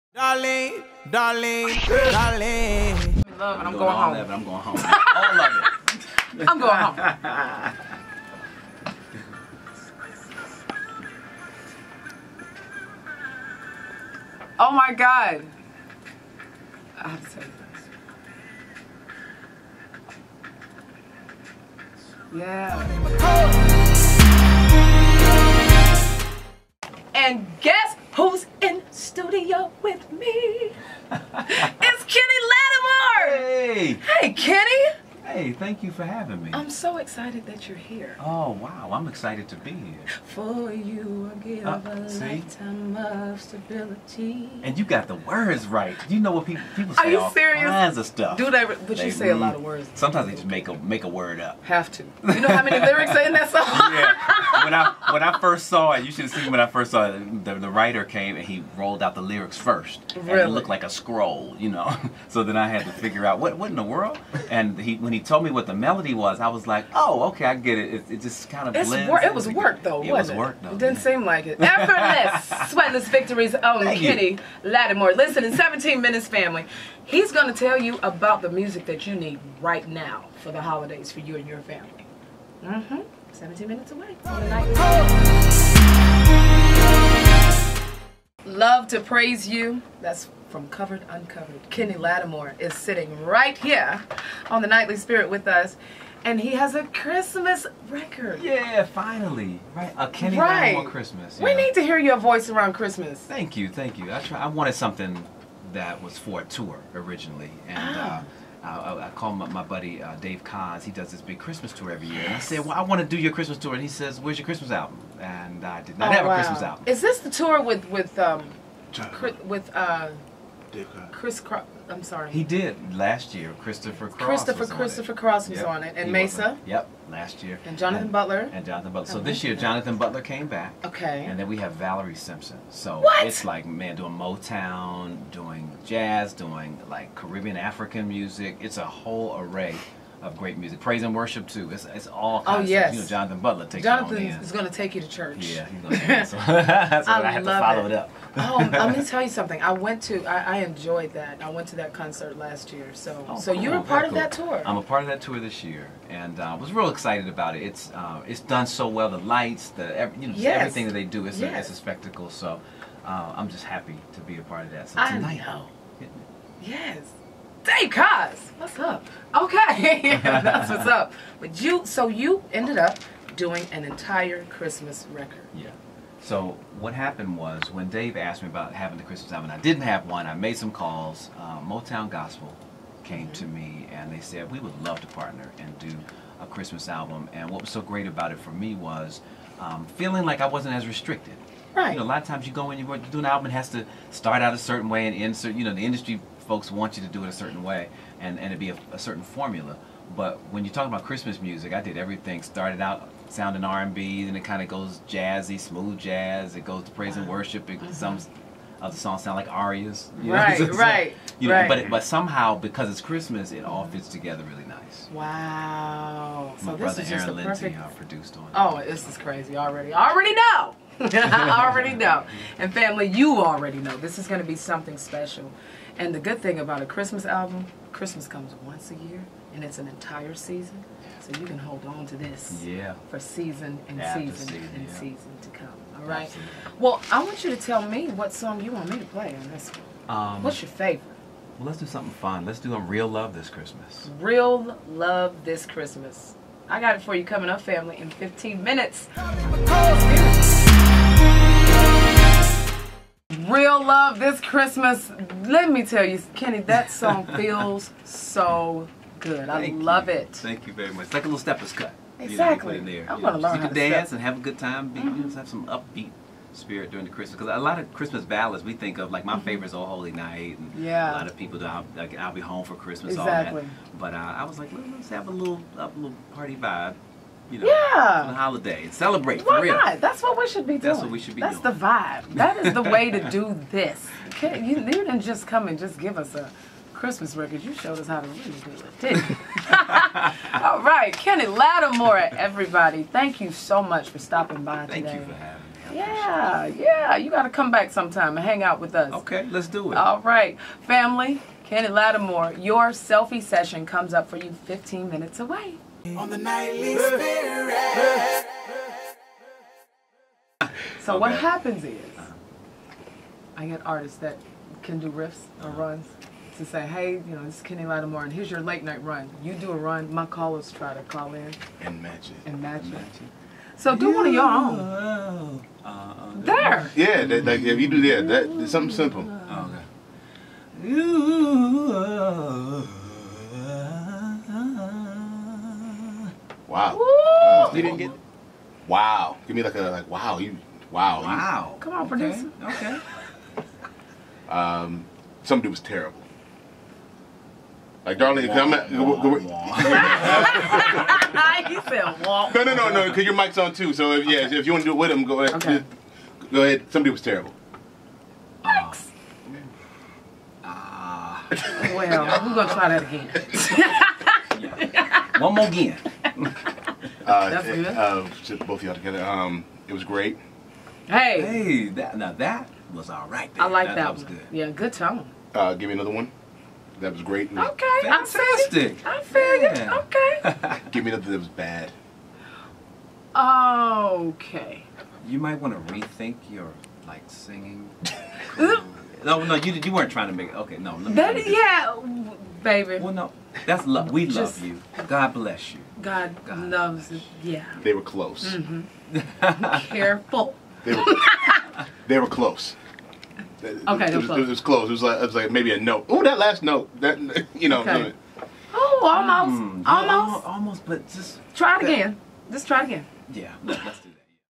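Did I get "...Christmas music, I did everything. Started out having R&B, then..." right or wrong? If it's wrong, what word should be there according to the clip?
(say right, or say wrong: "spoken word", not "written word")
wrong: "sounding", not "having".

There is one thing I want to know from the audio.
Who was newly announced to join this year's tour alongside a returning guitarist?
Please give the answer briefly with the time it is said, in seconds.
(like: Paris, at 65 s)
Valerie Simpson, at 131 s.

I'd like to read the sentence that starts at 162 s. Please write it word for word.
So, uh, I'm just happy to be a part of that.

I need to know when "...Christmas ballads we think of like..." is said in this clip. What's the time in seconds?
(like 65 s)
267 s.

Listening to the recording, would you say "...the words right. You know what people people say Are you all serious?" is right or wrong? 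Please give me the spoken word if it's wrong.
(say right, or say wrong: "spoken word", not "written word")
right.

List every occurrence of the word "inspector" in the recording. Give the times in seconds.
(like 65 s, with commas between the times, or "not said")
not said.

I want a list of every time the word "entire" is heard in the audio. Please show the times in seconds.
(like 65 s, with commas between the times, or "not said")
173 s, 229 s.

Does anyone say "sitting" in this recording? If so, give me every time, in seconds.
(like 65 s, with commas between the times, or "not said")
92 s.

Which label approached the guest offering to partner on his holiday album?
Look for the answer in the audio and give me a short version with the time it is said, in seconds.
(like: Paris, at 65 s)
Motown Gospel, at 181 s.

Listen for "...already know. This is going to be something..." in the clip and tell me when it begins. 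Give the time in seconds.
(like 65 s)
223 s.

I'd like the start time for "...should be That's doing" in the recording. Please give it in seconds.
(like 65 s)
281 s.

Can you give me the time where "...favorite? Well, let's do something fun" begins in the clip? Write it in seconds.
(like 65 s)
240 s.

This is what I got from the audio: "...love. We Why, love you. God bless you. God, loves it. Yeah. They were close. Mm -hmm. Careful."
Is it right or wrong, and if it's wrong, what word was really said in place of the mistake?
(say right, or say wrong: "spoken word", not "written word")
wrong: "Just", not "Why".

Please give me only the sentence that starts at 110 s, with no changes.
He does this big Christmas tour every year.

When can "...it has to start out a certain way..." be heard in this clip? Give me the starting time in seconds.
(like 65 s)
193 s.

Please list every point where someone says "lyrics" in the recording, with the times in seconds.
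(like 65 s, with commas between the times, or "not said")
52 s, 59 s.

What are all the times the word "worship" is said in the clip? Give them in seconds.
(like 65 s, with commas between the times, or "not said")
141 s, 207 s.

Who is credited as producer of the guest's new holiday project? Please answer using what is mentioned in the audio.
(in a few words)
Aaron Lindsey.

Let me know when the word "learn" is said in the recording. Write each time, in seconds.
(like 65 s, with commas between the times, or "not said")
263 s.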